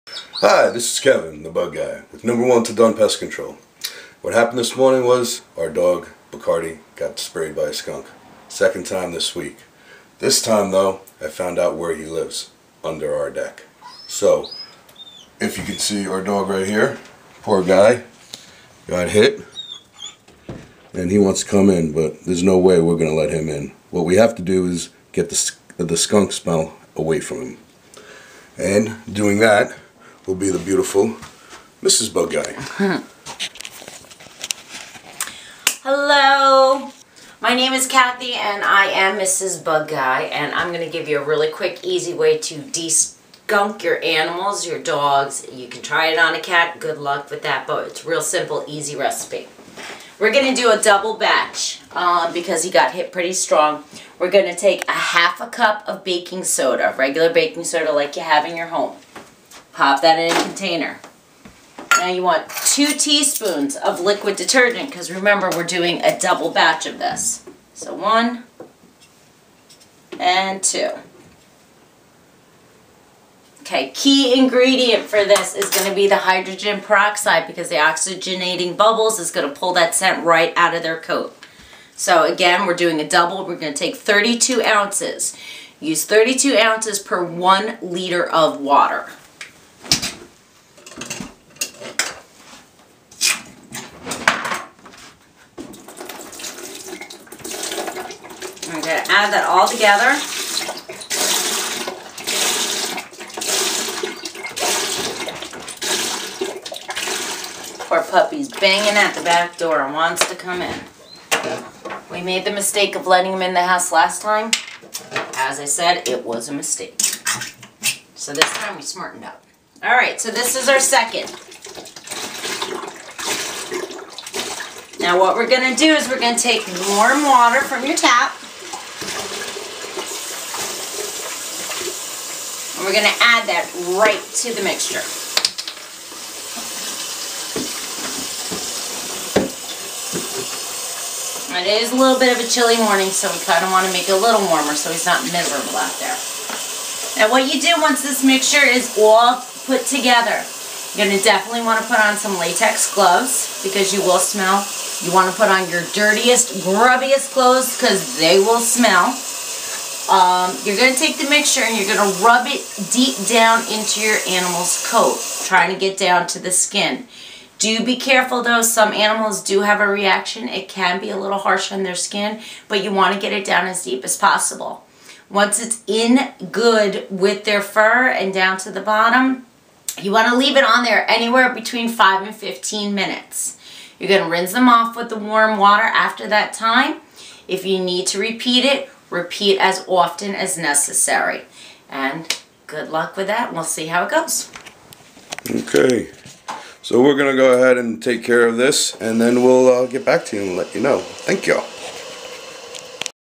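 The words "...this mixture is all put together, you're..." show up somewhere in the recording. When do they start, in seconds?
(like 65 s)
148 s.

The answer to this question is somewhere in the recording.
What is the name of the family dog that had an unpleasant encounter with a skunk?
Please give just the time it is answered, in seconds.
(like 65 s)
6 s.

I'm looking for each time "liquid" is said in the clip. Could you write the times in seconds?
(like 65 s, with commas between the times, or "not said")
64 s.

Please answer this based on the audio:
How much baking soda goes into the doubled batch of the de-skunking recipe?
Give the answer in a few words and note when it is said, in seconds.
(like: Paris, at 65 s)
Half a cup, at 54 s.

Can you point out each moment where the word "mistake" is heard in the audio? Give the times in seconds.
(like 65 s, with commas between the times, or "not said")
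112 s, 116 s.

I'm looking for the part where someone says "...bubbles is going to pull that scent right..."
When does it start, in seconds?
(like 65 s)
78 s.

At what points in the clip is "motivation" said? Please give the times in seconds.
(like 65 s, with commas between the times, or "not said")
not said.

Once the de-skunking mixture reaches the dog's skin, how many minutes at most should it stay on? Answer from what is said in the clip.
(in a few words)
15.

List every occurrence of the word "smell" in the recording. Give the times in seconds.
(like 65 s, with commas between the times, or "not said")
26 s, 154 s, 158 s.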